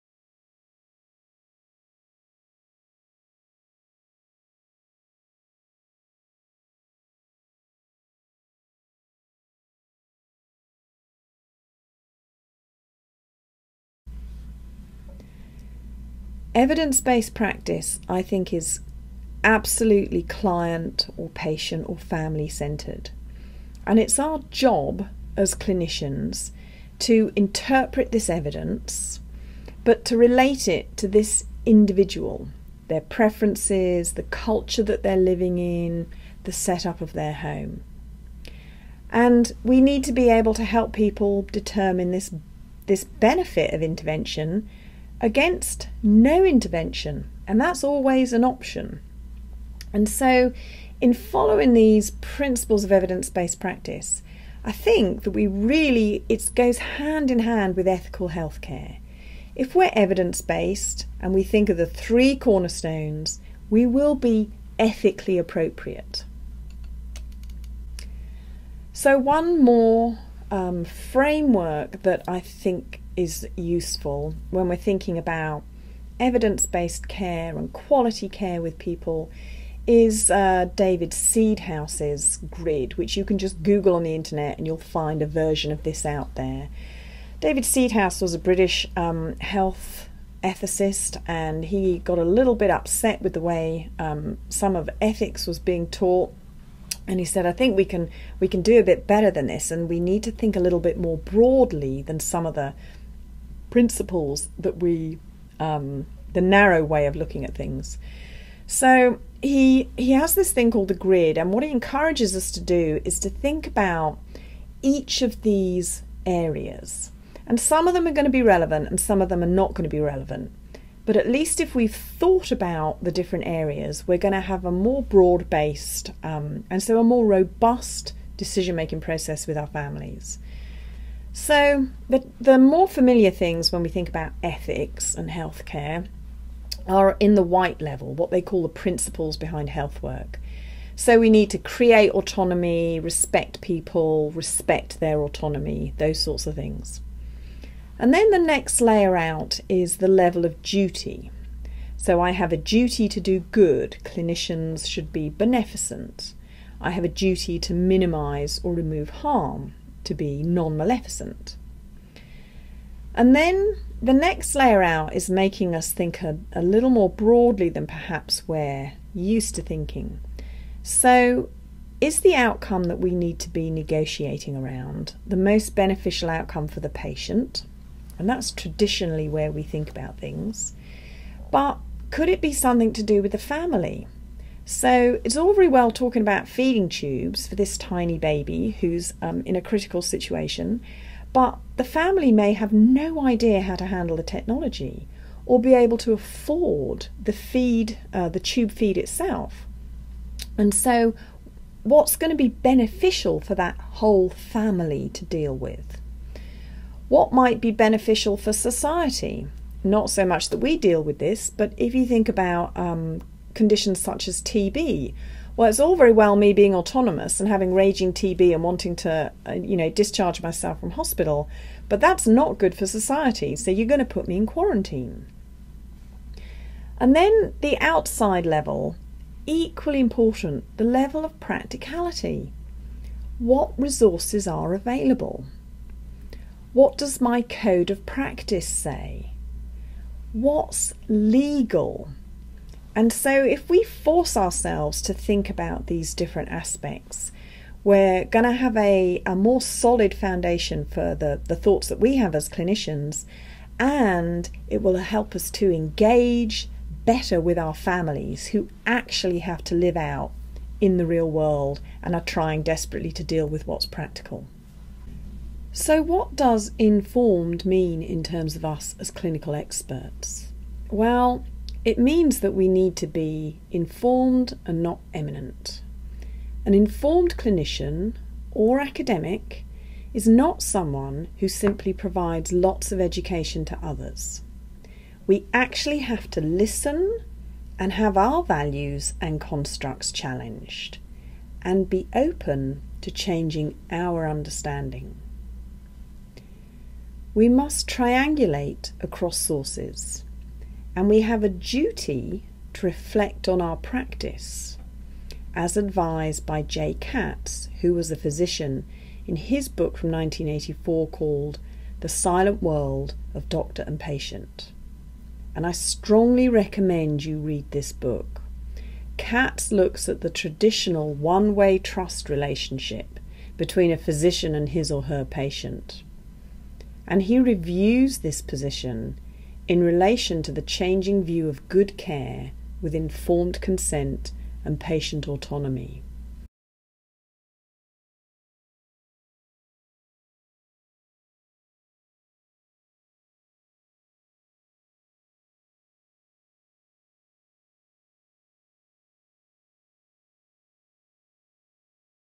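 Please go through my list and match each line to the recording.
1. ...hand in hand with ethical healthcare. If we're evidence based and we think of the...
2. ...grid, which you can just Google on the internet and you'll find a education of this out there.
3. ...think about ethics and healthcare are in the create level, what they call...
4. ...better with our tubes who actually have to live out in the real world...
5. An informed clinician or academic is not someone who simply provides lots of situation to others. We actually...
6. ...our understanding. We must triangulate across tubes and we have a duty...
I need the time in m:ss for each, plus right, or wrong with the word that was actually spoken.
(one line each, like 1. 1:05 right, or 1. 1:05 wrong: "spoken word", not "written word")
1. 0:56 right
2. 1:22 wrong: "version", not "education"
3. 2:13 wrong: "white", not "create"
4. 4:17 wrong: "families", not "tubes"
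5. 4:36 wrong: "education", not "situation"
6. 4:53 wrong: "sources", not "tubes".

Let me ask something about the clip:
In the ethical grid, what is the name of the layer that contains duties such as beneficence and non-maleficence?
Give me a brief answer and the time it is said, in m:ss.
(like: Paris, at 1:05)
level of duty, at 2:30.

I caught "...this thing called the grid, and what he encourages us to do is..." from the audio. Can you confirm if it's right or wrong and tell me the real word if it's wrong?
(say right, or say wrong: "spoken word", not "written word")
right.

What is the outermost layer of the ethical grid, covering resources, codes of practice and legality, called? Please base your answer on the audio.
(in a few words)
level of practicality.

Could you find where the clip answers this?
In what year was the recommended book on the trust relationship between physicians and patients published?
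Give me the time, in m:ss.
5:10.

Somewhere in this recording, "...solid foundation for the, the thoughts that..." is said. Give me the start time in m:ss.
4:09.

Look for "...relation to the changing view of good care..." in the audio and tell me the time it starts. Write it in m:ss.
5:29.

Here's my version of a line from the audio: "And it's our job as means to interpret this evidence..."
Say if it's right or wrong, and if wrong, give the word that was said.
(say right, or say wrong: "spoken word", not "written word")
wrong: "clinicians", not "means".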